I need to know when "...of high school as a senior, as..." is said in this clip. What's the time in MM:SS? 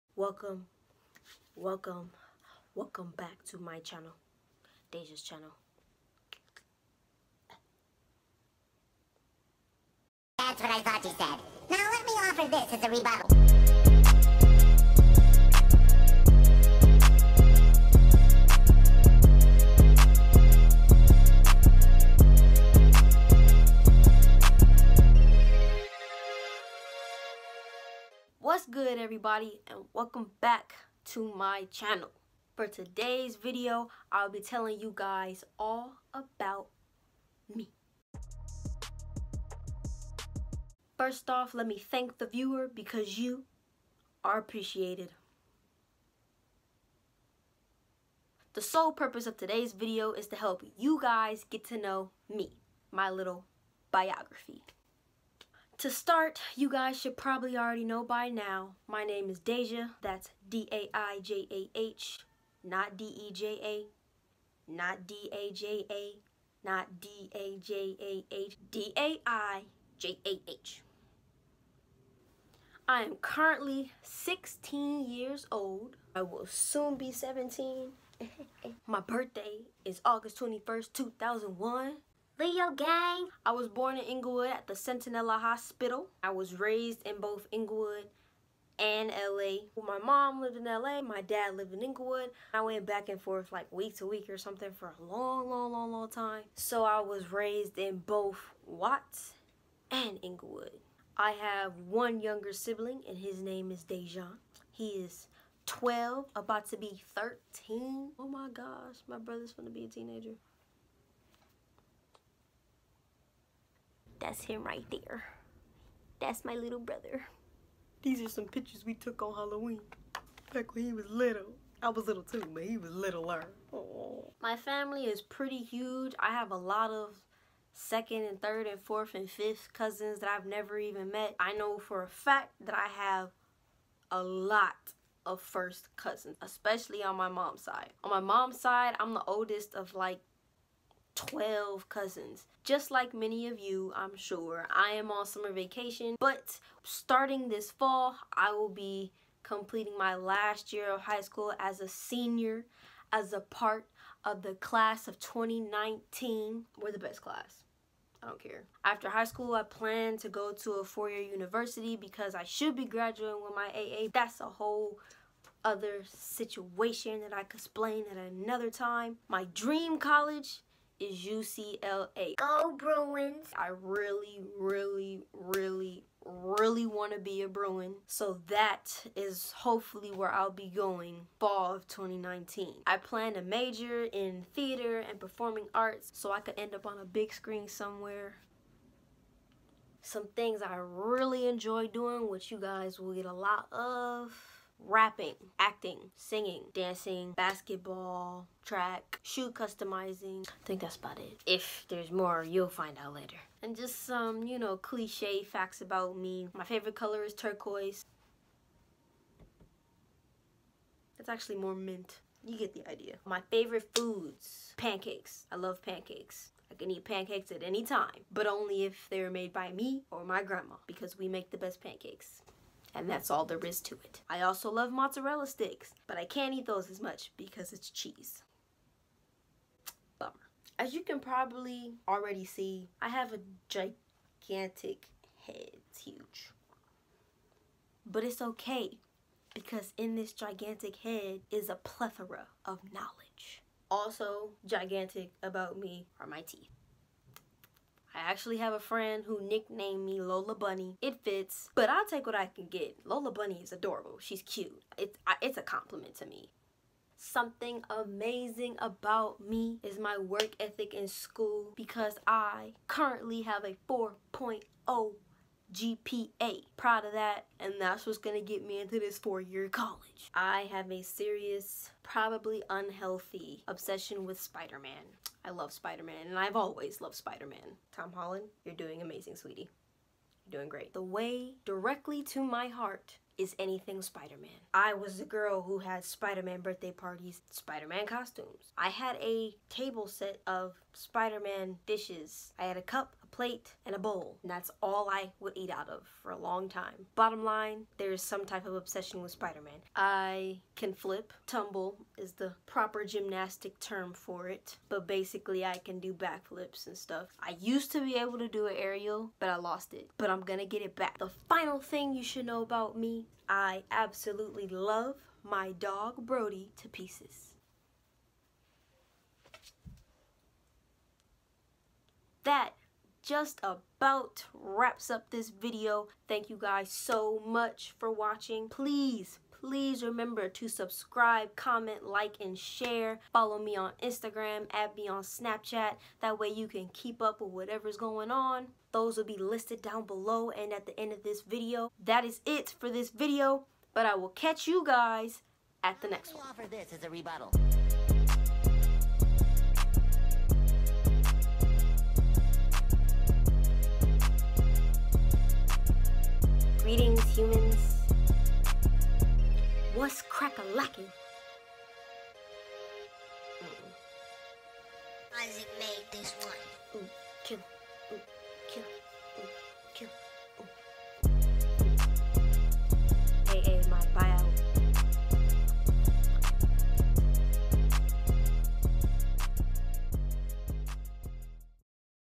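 02:30.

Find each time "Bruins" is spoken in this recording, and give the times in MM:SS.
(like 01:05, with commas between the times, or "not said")
02:52, 02:57.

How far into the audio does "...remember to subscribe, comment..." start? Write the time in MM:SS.
05:30.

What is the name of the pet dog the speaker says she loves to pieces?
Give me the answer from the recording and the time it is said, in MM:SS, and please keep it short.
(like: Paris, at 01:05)
Brody, at 05:16.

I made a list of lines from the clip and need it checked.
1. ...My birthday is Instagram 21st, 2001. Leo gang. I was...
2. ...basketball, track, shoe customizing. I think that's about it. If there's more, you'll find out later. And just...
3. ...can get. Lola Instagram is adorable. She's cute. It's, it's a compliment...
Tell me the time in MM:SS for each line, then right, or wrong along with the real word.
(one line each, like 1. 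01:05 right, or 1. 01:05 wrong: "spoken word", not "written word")
1. 01:18 wrong: "August", not "Instagram"
2. 03:17 right
3. 04:12 wrong: "Bunny", not "Instagram".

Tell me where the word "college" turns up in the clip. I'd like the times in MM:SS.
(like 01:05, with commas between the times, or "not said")
02:49, 04:29.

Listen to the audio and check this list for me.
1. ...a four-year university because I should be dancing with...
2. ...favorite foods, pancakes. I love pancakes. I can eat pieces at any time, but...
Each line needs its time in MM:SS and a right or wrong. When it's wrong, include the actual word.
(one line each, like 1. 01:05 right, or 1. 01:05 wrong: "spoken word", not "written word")
1. 02:40 wrong: "graduating", not "dancing"
2. 03:33 wrong: "pancakes", not "pieces".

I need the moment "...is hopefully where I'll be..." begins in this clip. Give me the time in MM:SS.
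02:59.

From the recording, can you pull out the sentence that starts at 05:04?
But basically I can do backflips and stuff.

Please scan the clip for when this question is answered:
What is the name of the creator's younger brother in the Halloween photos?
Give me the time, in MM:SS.
01:43.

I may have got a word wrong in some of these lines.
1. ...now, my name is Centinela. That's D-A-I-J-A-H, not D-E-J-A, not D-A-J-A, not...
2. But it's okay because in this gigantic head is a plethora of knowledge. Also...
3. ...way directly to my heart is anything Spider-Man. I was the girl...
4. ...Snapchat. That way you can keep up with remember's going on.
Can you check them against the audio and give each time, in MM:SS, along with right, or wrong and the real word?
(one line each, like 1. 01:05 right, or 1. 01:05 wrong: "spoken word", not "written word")
1. 00:58 wrong: "Daijah", not "Centinela"
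2. 03:58 right
3. 04:41 right
4. 05:35 wrong: "whatever", not "remember".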